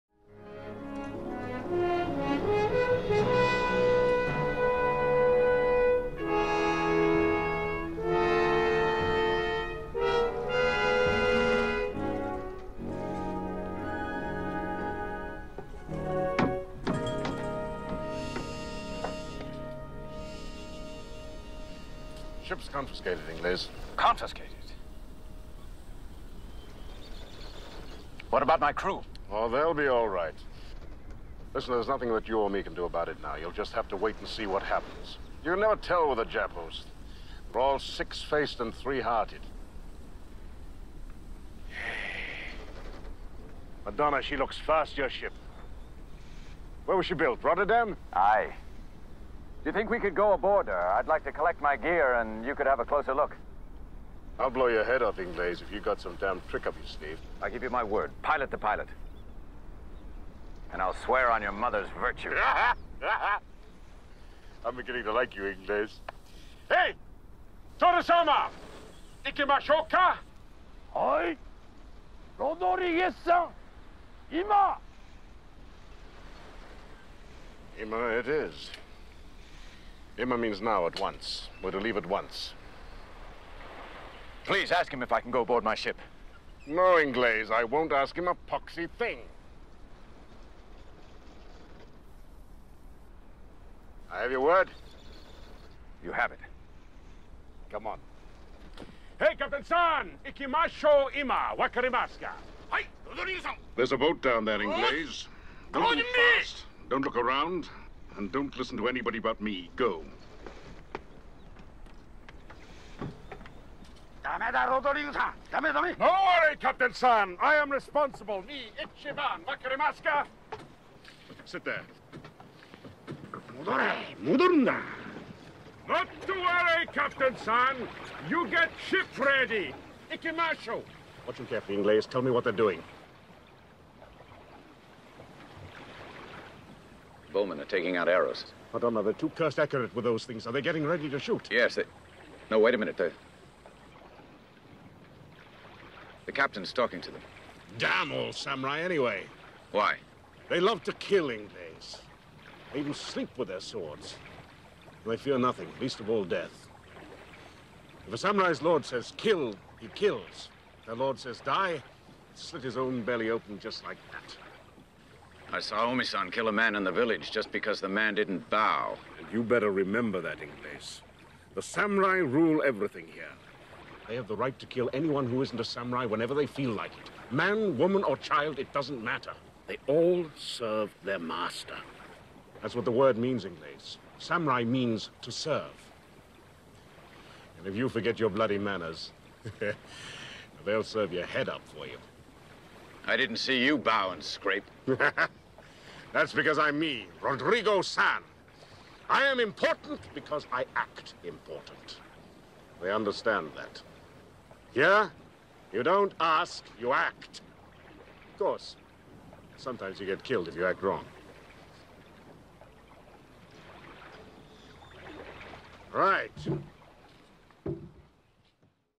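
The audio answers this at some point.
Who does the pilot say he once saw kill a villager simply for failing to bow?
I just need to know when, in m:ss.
2:45.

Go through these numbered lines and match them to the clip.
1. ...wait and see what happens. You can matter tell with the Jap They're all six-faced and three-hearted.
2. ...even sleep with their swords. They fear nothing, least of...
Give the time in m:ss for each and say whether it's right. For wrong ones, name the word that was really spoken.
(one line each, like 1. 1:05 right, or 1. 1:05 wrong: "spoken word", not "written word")
1. 0:33 wrong: "never", not "matter"
2. 2:32 right.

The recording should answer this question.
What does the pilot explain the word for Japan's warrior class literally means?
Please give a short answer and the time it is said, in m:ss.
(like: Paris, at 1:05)
to serve, at 3:05.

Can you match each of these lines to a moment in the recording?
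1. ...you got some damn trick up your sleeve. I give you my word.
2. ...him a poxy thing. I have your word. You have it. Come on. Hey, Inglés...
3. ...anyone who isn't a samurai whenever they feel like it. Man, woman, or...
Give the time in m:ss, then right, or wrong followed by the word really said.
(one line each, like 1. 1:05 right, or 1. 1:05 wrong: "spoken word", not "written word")
1. 0:55 right
2. 1:28 wrong: "Captain", not "Inglés"
3. 2:54 right.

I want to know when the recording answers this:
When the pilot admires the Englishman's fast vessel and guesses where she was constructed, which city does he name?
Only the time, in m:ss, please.
0:47.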